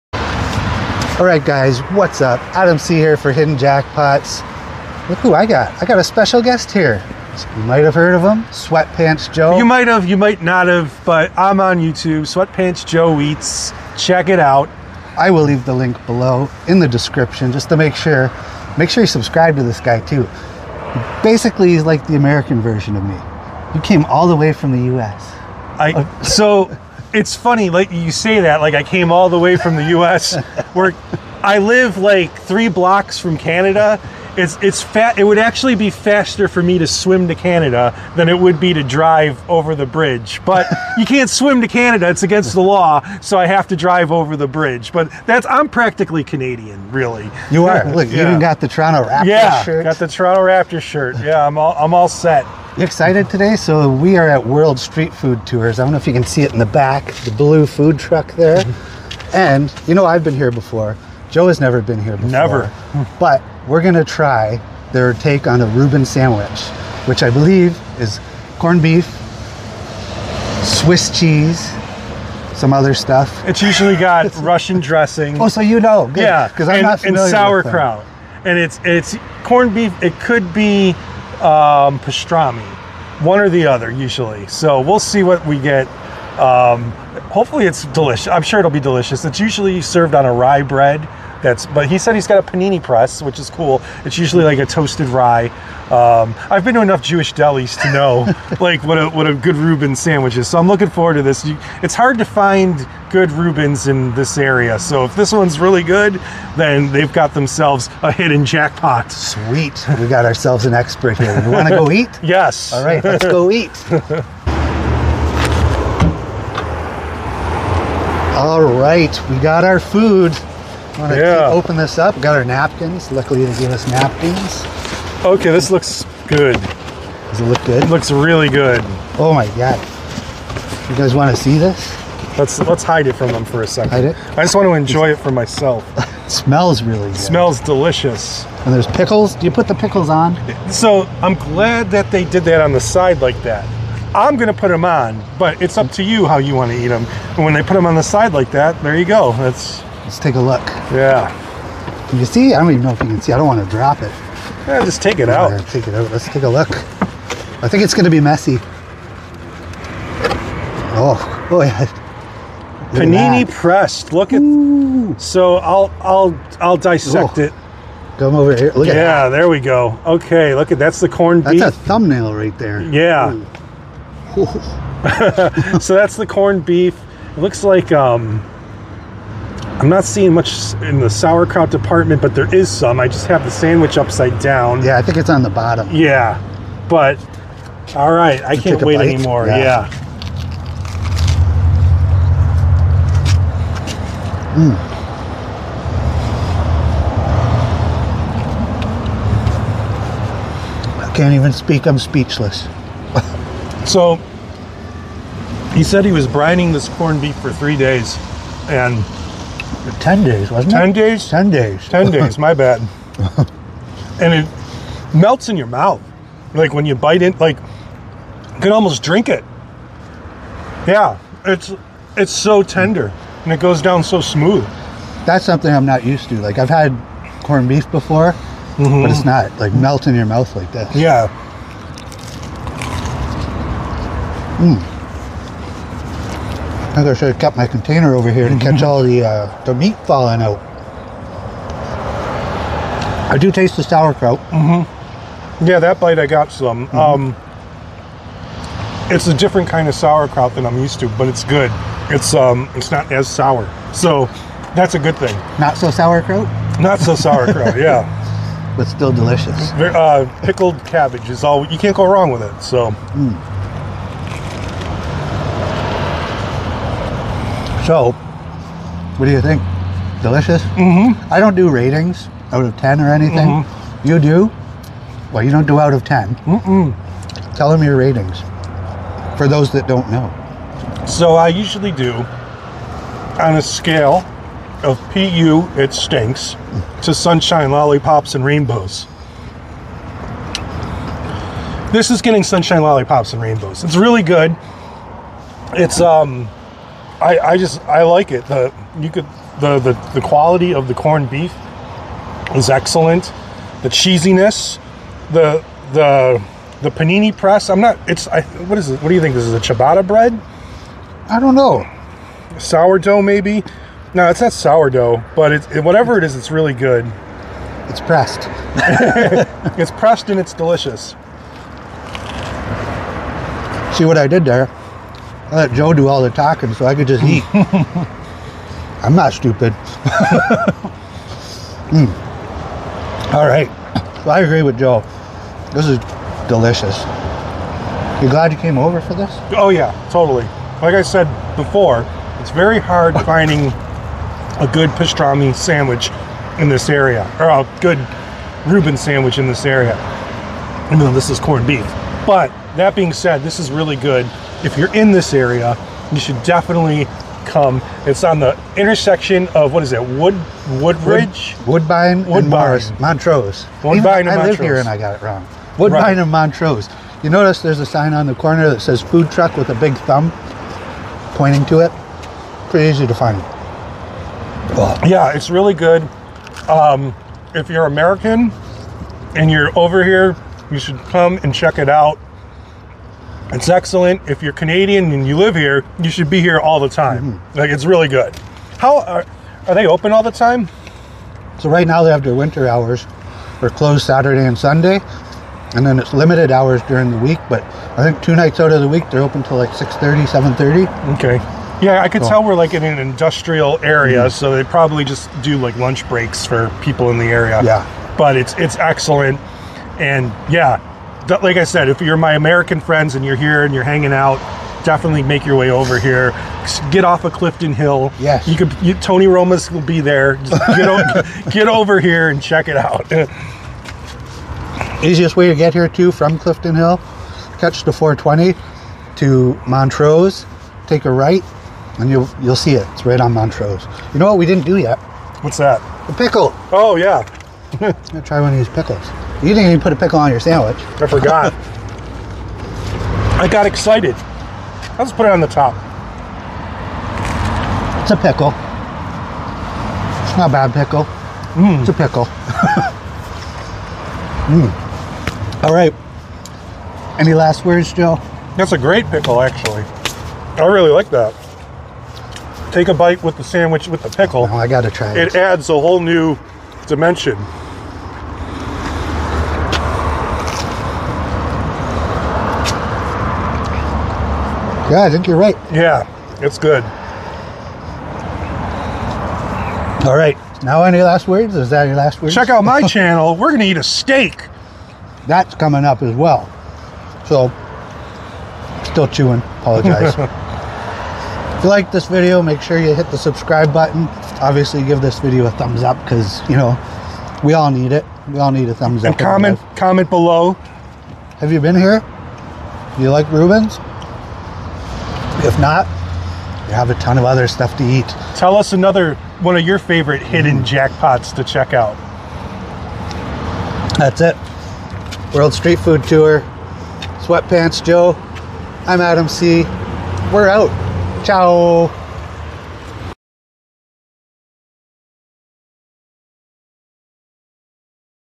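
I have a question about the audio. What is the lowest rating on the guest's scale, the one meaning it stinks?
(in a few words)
PU.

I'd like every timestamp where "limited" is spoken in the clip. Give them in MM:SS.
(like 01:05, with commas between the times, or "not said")
06:36.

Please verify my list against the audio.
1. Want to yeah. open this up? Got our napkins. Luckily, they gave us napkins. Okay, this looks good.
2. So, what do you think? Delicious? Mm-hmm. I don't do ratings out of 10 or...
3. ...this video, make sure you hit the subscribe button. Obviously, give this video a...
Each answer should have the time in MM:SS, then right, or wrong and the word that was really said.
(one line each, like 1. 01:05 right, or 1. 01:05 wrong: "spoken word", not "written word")
1. 02:00 right
2. 04:27 right
3. 08:11 right.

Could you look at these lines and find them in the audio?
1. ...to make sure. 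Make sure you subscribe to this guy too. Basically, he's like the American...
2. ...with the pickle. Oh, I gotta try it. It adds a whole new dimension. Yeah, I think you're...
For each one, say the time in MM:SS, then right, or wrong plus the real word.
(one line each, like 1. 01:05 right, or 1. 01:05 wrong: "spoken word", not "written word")
1. 00:17 right
2. 07:43 right.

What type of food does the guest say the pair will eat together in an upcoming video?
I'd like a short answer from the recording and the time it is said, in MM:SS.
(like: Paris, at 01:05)
steak, at 08:03.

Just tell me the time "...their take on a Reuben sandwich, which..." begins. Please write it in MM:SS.
01:04.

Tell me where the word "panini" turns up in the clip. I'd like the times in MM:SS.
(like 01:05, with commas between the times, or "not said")
01:32, 02:43, 05:06.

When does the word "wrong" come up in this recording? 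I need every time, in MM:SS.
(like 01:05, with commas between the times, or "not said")
04:22, 06:05.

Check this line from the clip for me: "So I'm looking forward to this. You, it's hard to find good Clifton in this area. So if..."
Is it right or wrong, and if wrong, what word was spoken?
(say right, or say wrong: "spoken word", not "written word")
wrong: "Reubens", not "Clifton".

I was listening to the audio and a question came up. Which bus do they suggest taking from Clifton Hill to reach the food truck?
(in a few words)
420.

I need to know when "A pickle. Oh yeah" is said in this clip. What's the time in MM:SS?
07:16.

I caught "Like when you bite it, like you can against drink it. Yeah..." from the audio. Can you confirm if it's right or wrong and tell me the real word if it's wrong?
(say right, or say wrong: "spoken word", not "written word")
wrong: "almost", not "against".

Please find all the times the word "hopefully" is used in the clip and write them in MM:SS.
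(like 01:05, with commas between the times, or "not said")
01:27.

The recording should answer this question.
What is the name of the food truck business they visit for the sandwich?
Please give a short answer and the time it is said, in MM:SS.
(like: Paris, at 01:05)
World Street Food Tours, at 00:54.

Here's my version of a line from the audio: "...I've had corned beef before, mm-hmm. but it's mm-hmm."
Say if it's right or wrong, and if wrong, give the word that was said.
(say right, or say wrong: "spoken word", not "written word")
right.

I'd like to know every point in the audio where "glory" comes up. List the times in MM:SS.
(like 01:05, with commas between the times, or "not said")
not said.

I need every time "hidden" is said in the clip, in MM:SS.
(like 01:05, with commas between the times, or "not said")
00:03, 01:48, 08:30.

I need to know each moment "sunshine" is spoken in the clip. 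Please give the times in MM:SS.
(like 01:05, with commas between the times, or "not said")
04:47, 04:52.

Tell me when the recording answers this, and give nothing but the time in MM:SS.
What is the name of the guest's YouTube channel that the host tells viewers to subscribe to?
00:12.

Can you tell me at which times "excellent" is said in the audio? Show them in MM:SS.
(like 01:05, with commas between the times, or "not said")
05:02, 06:23, 06:48.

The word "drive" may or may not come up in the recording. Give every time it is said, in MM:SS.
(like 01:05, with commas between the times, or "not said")
00:38, 00:43.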